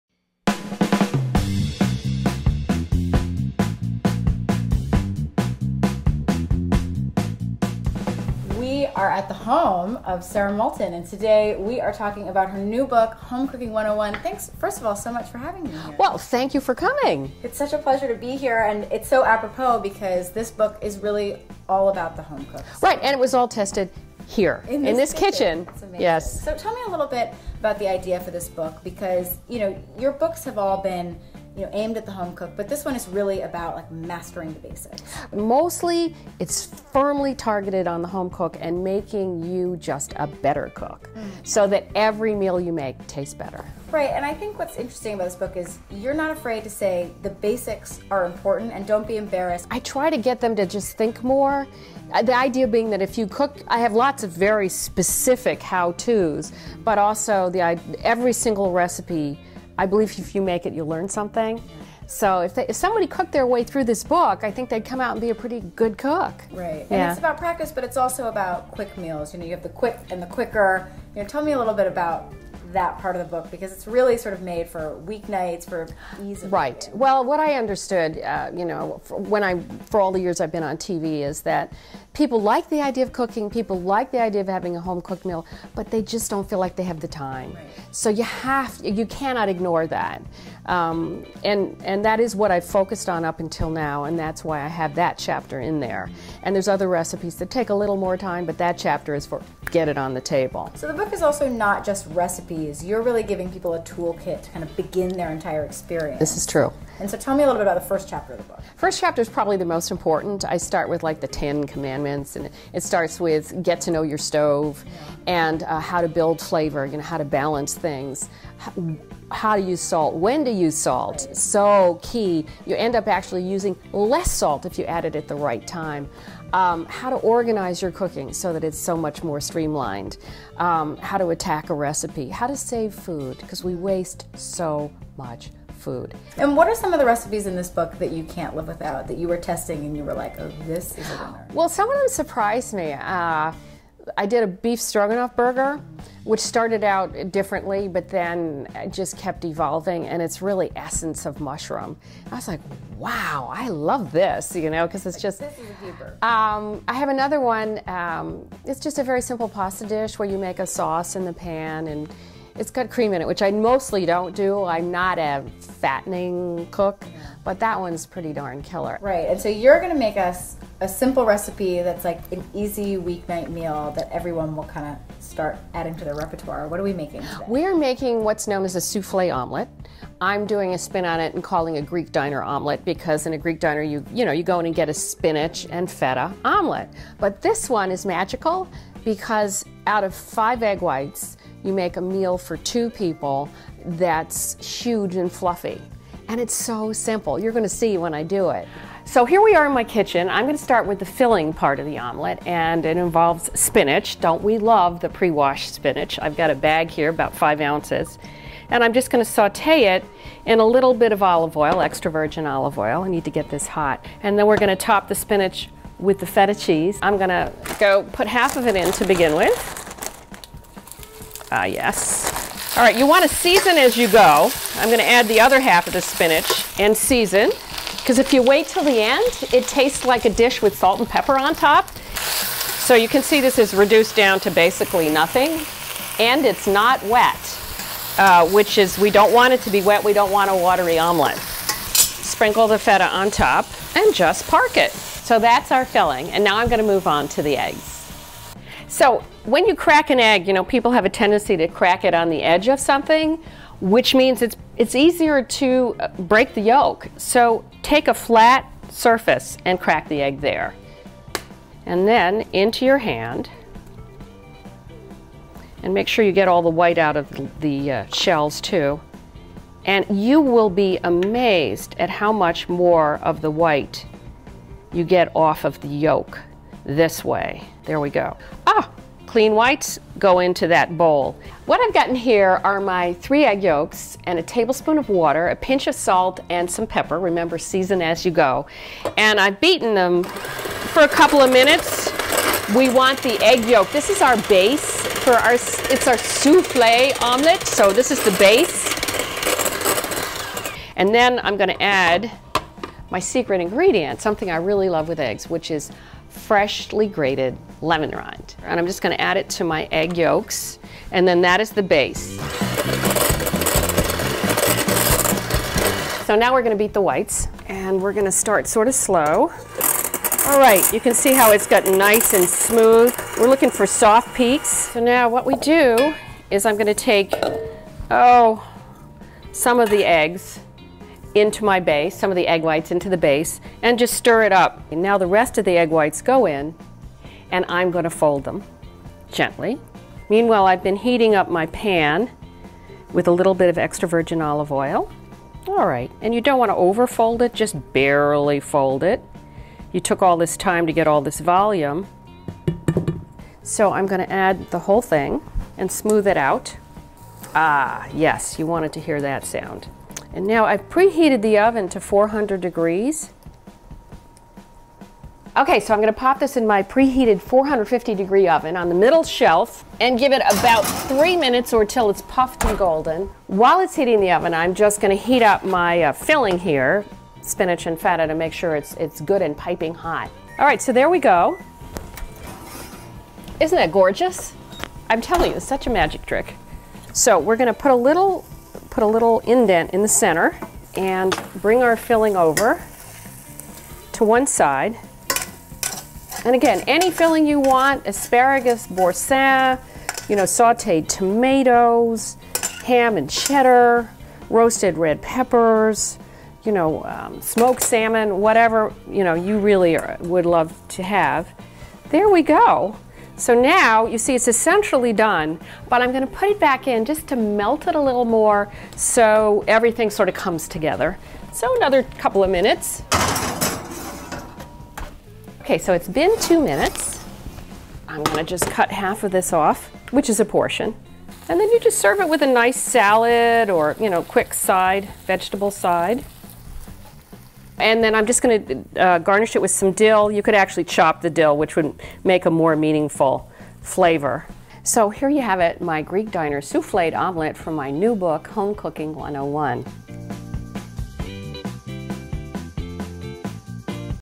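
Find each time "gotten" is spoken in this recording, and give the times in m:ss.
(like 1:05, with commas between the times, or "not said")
4:41, 5:21.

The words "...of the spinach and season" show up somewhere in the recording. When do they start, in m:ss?
3:45.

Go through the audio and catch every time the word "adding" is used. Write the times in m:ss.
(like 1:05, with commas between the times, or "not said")
2:55.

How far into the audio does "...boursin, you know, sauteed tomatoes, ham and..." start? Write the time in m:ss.
6:38.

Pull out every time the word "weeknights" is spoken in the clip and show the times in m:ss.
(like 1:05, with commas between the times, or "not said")
1:15, 2:52.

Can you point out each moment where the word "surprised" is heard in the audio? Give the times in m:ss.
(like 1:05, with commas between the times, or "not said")
2:22.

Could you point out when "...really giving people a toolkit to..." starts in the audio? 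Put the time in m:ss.
1:43.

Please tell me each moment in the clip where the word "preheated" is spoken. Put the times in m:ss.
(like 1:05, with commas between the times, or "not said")
6:00, 6:06.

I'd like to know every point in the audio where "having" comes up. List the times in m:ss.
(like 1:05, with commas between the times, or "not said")
0:15, 1:24.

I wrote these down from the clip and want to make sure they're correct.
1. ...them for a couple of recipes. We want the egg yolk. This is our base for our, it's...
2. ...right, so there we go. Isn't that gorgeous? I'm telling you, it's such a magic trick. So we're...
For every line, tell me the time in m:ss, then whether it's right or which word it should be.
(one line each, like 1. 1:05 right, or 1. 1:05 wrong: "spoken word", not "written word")
1. 4:49 wrong: "minutes", not "recipes"
2. 6:20 right.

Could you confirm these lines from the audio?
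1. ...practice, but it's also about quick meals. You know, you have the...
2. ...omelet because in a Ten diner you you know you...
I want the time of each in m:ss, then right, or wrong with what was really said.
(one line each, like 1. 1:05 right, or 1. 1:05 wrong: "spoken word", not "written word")
1. 1:07 right
2. 3:02 wrong: "Greek", not "Ten".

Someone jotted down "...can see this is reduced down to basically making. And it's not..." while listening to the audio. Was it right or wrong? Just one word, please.
wrong.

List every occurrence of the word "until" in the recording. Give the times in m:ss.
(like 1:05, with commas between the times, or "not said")
1:33.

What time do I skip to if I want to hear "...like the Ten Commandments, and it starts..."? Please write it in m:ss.
1:51.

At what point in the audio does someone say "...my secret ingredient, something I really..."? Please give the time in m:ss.
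5:03.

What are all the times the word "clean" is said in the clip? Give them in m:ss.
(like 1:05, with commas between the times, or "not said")
4:39.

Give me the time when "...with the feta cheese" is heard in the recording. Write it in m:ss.
3:35.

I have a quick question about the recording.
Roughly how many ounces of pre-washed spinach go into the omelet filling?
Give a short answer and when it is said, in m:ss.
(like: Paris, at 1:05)
5 ounces, at 3:27.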